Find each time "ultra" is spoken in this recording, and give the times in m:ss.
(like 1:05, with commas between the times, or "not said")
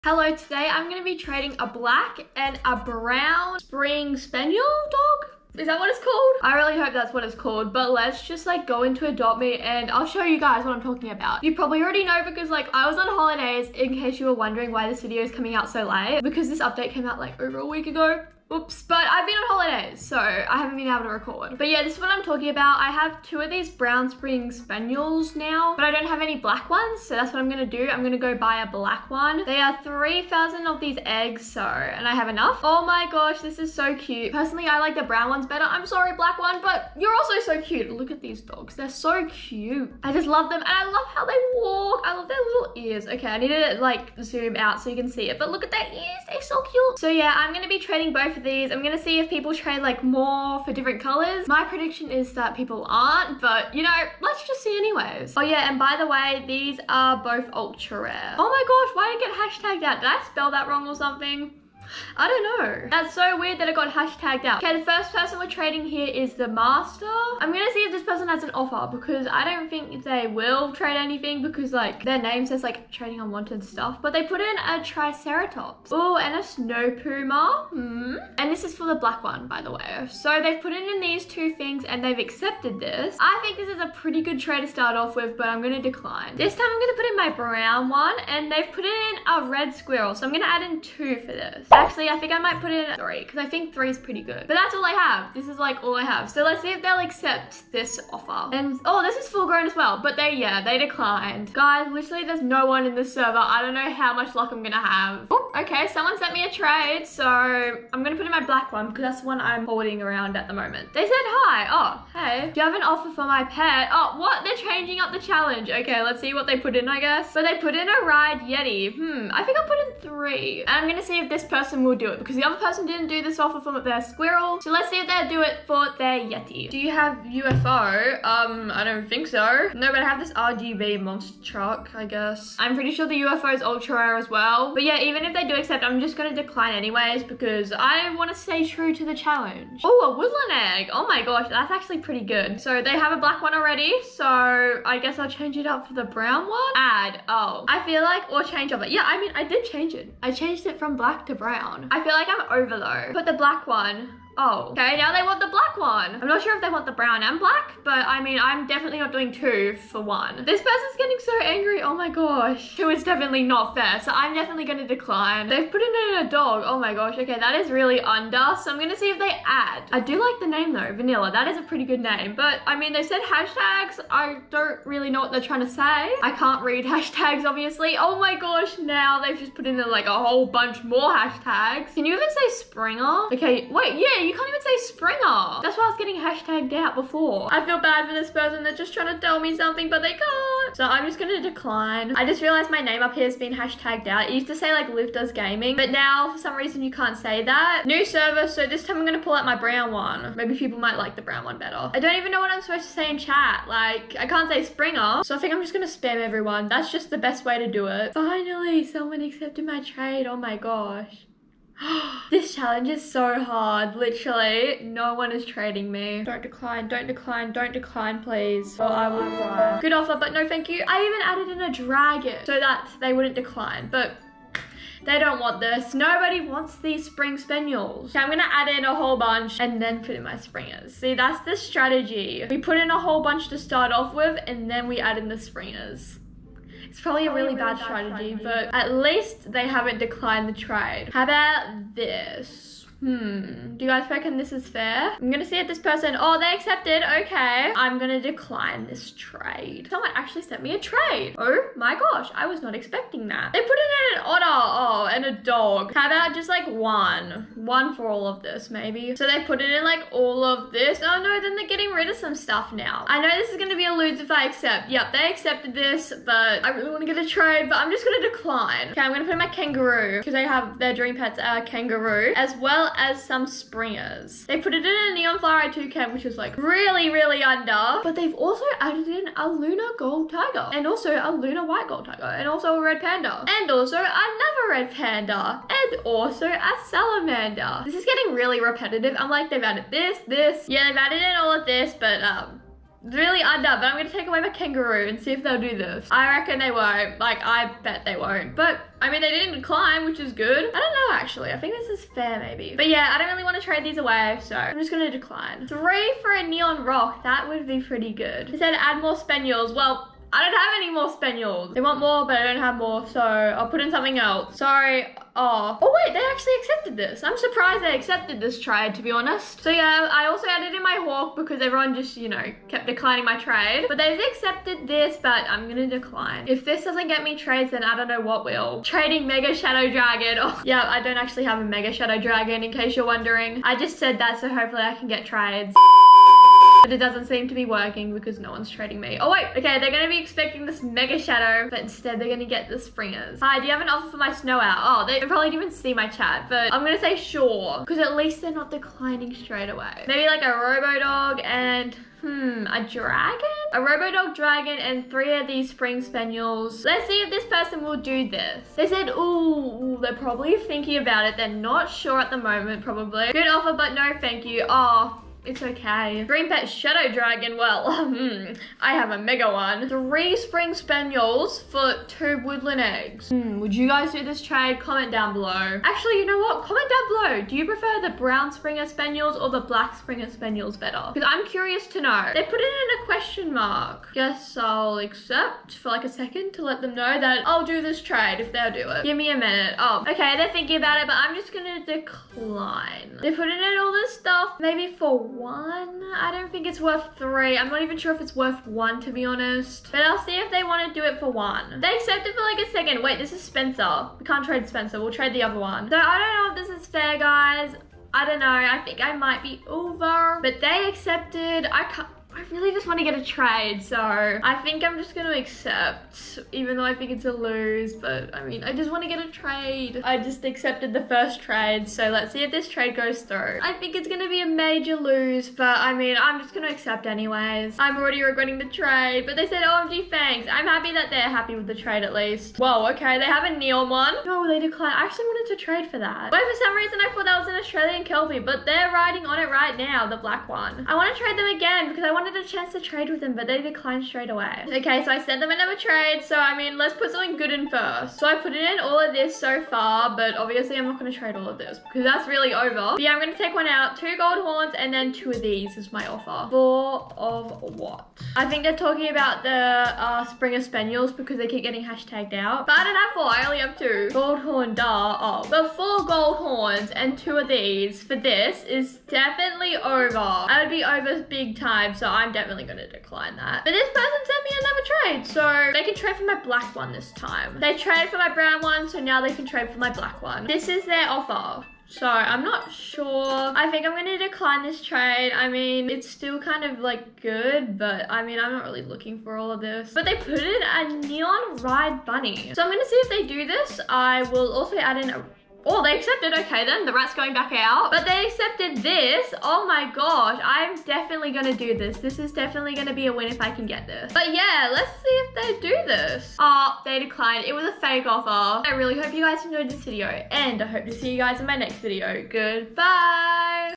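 0:57, 2:13.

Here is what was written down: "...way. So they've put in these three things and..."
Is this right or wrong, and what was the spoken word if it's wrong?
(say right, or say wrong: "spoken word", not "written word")
wrong: "two", not "three".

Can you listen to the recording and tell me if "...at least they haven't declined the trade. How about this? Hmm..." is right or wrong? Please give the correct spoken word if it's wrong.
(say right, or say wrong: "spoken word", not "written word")
right.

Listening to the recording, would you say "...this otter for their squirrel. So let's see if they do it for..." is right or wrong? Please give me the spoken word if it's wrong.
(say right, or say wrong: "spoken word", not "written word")
wrong: "offer", not "otter".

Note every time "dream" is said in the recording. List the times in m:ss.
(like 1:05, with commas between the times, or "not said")
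4:30.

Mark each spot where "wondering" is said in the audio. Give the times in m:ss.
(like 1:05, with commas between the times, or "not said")
0:14, 5:33.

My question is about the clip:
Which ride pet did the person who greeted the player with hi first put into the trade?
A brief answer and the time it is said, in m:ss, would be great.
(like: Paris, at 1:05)
ride Yeti, at 1:58.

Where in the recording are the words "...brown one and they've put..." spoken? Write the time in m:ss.
1:27.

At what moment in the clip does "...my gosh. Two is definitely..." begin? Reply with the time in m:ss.
2:41.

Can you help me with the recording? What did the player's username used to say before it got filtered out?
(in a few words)
Liv does gaming.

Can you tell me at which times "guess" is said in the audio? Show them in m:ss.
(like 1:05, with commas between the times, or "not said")
1:56, 2:12, 2:24, 6:24.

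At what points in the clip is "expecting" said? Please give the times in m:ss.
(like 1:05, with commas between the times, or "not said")
4:12, 5:40.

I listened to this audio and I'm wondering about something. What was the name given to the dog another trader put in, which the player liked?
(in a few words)
Vanilla.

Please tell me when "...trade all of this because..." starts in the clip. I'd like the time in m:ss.
7:31.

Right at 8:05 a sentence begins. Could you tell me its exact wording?
I mean, it's still kind of like good, but I mean, I'm not really looking for all of this.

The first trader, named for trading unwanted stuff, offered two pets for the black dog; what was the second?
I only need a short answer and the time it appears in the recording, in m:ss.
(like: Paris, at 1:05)
snow puma, at 1:16.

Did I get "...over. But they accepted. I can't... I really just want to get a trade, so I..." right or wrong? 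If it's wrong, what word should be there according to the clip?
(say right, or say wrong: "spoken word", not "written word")
right.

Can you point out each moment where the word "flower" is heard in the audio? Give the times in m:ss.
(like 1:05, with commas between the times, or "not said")
4:35.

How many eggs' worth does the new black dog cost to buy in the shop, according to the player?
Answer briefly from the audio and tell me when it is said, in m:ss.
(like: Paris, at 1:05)
3,000, at 0:29.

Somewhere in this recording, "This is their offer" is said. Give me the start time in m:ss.
8:00.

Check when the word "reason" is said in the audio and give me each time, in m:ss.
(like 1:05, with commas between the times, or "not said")
3:16, 7:16.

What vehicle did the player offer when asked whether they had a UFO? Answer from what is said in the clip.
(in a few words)
RGB monster truck.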